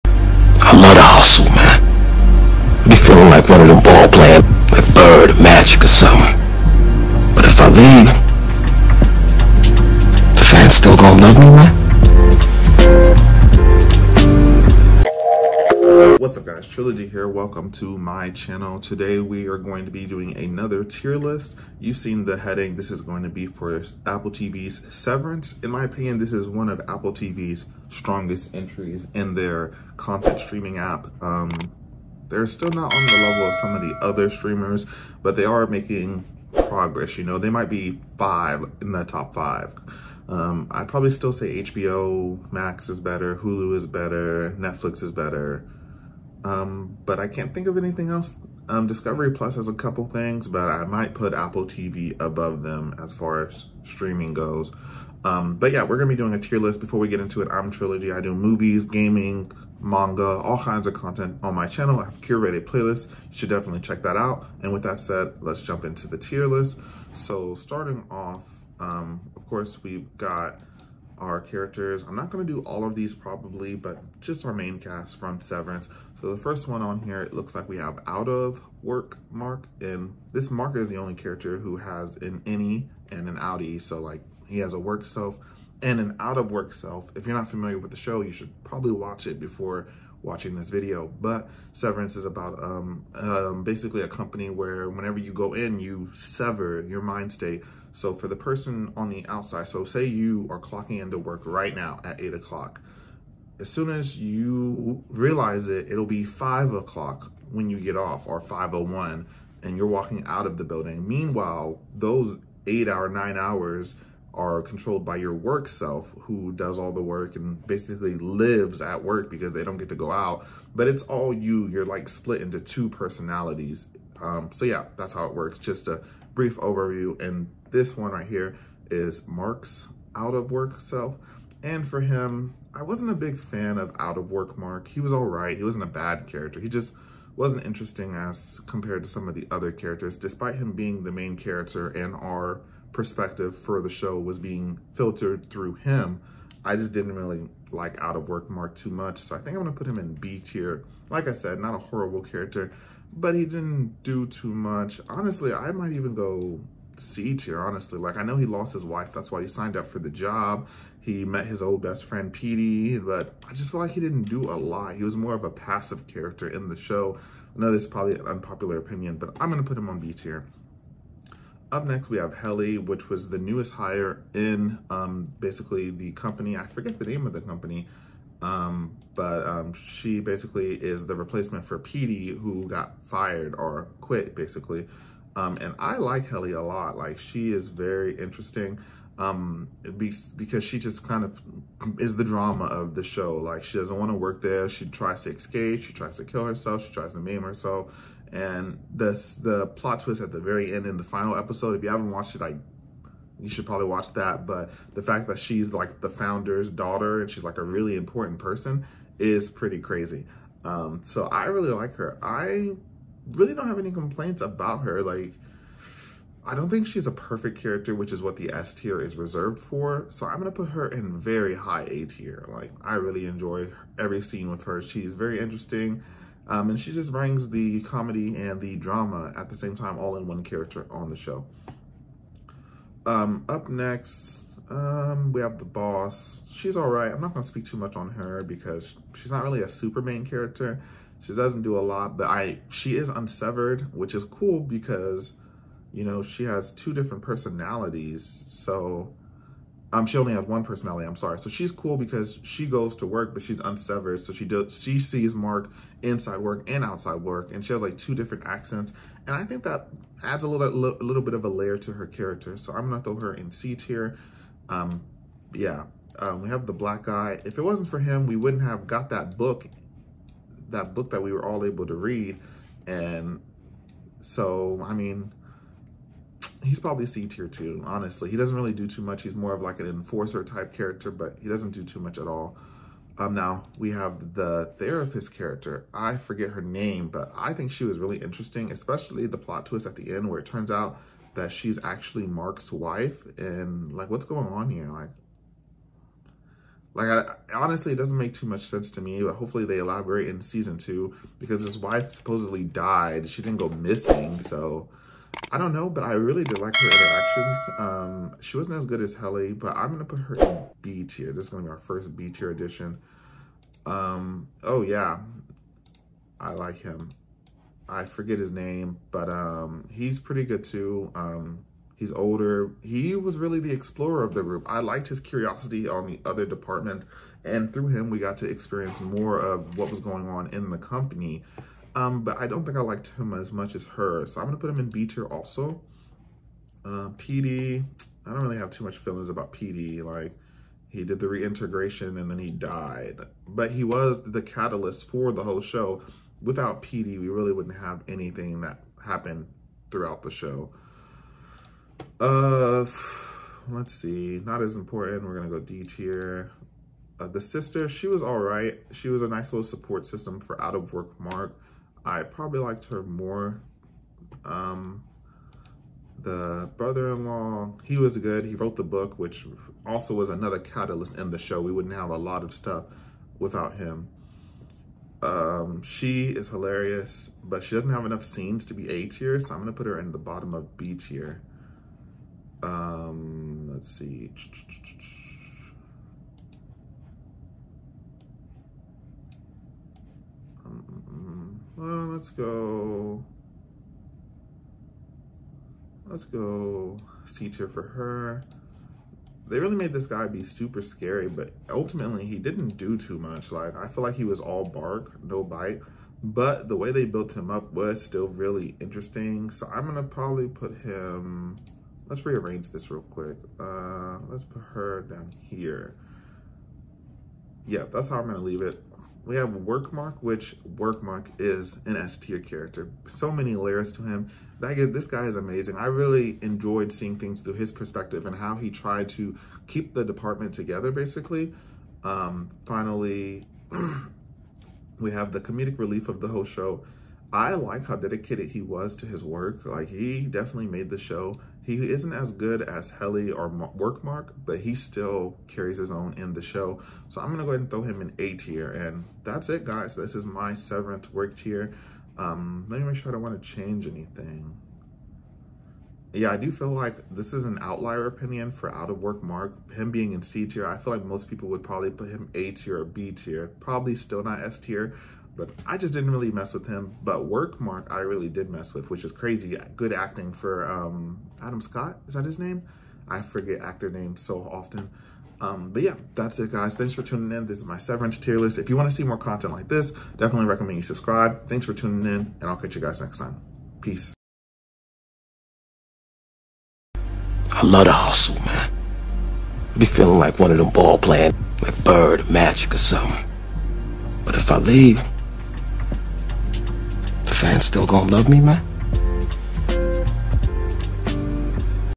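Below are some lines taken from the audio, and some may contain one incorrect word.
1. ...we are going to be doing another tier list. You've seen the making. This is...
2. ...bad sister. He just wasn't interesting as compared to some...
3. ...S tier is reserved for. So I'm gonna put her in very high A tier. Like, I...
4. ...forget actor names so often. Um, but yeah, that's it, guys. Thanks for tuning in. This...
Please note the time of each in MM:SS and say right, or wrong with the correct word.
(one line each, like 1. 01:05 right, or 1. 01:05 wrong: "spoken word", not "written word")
1. 00:19 wrong: "heading", not "making"
2. 02:15 wrong: "character", not "sister"
3. 03:38 right
4. 07:53 right.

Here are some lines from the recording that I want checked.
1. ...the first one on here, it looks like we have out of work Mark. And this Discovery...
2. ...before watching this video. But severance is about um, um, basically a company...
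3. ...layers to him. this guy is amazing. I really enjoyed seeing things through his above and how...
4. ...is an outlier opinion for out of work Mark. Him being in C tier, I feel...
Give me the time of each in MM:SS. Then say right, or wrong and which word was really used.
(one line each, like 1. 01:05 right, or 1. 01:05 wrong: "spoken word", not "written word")
1. 01:16 wrong: "Mark", not "Discovery"
2. 01:29 right
3. 07:03 wrong: "perspective", not "above"
4. 07:37 right.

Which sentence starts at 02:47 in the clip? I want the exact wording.
I know this is probably an unpopular opinion, but I'm going to put him on B tier.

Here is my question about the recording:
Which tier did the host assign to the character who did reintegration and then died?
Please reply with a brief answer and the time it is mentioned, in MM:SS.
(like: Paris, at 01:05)
D tier, at 05:55.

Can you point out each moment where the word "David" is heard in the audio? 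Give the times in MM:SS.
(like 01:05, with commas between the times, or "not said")
not said.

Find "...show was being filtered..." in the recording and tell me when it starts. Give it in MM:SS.
02:23.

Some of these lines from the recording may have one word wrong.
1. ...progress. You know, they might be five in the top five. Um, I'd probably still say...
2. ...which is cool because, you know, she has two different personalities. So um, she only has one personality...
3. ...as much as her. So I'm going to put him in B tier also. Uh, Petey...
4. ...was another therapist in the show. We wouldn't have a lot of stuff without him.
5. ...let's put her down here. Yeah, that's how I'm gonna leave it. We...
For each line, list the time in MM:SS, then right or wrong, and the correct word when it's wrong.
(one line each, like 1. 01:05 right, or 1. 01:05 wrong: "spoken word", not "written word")
1. 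00:36 right
2. 04:03 right
3. 05:33 right
4. 06:10 wrong: "catalyst", not "therapist"
5. 06:54 right.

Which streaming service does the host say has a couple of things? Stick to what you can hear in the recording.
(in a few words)
Discovery Plus.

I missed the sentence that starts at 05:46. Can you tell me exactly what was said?
Without Petey, we really wouldn't have anything that happened throughout the show.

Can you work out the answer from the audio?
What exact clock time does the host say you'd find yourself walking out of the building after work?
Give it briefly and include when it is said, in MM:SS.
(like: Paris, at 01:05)
5:01, at 01:48.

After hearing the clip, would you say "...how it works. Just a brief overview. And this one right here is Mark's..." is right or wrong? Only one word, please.
right.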